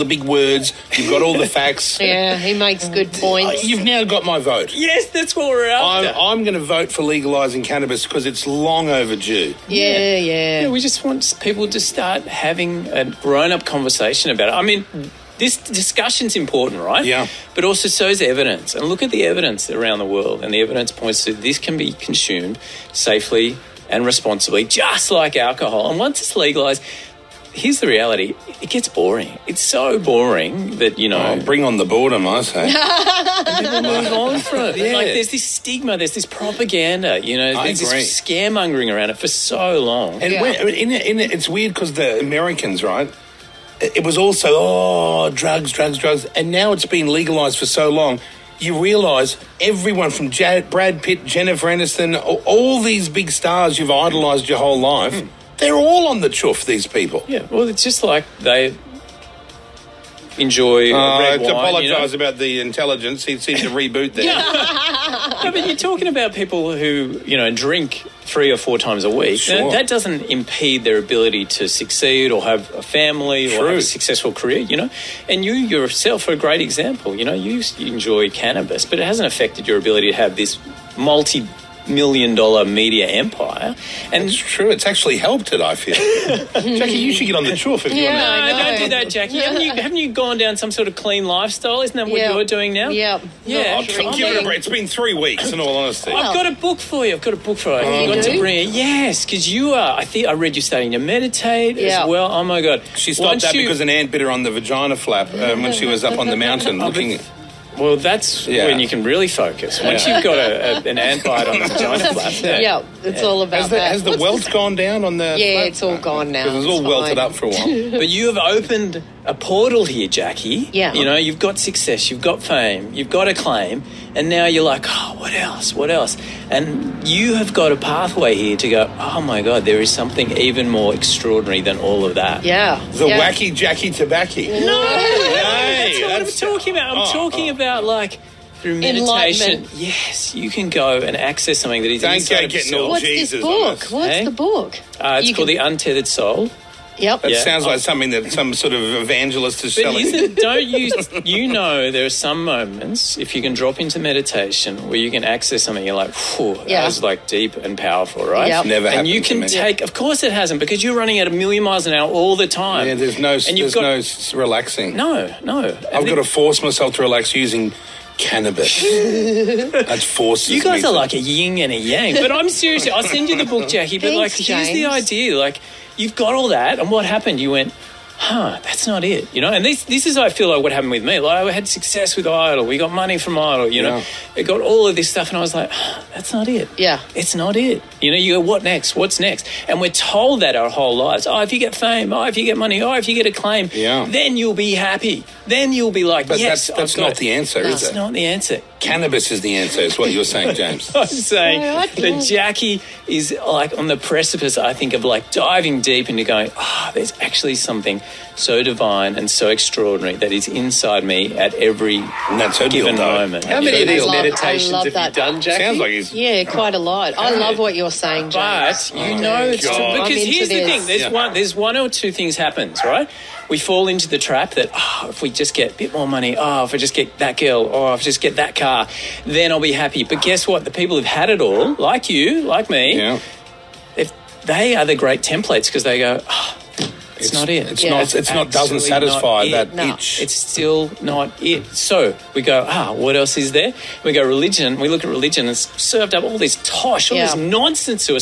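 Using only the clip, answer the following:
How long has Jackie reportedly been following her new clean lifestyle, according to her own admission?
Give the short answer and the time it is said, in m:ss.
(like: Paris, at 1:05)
3 weeks, at 1:34.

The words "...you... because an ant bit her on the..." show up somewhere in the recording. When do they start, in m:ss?
1:43.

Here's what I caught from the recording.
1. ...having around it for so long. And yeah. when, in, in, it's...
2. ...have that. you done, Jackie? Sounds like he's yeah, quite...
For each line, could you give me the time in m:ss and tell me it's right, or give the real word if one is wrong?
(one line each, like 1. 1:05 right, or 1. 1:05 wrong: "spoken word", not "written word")
1. 0:38 wrong: "scaremongering", not "having"
2. 3:34 right.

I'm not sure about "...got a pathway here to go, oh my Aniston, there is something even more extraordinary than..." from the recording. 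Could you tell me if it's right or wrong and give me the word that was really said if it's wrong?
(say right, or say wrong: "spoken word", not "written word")
wrong: "God", not "Aniston".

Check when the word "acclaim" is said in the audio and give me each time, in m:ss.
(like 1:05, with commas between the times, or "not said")
2:03, 3:13.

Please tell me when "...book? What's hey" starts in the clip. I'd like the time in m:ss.
2:23.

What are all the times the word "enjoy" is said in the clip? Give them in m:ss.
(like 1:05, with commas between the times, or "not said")
1:00, 1:17.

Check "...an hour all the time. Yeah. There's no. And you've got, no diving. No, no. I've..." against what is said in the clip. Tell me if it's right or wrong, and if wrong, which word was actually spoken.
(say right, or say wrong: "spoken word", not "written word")
wrong: "relaxing", not "diving".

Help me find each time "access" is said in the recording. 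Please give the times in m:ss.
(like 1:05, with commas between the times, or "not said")
2:21, 2:35.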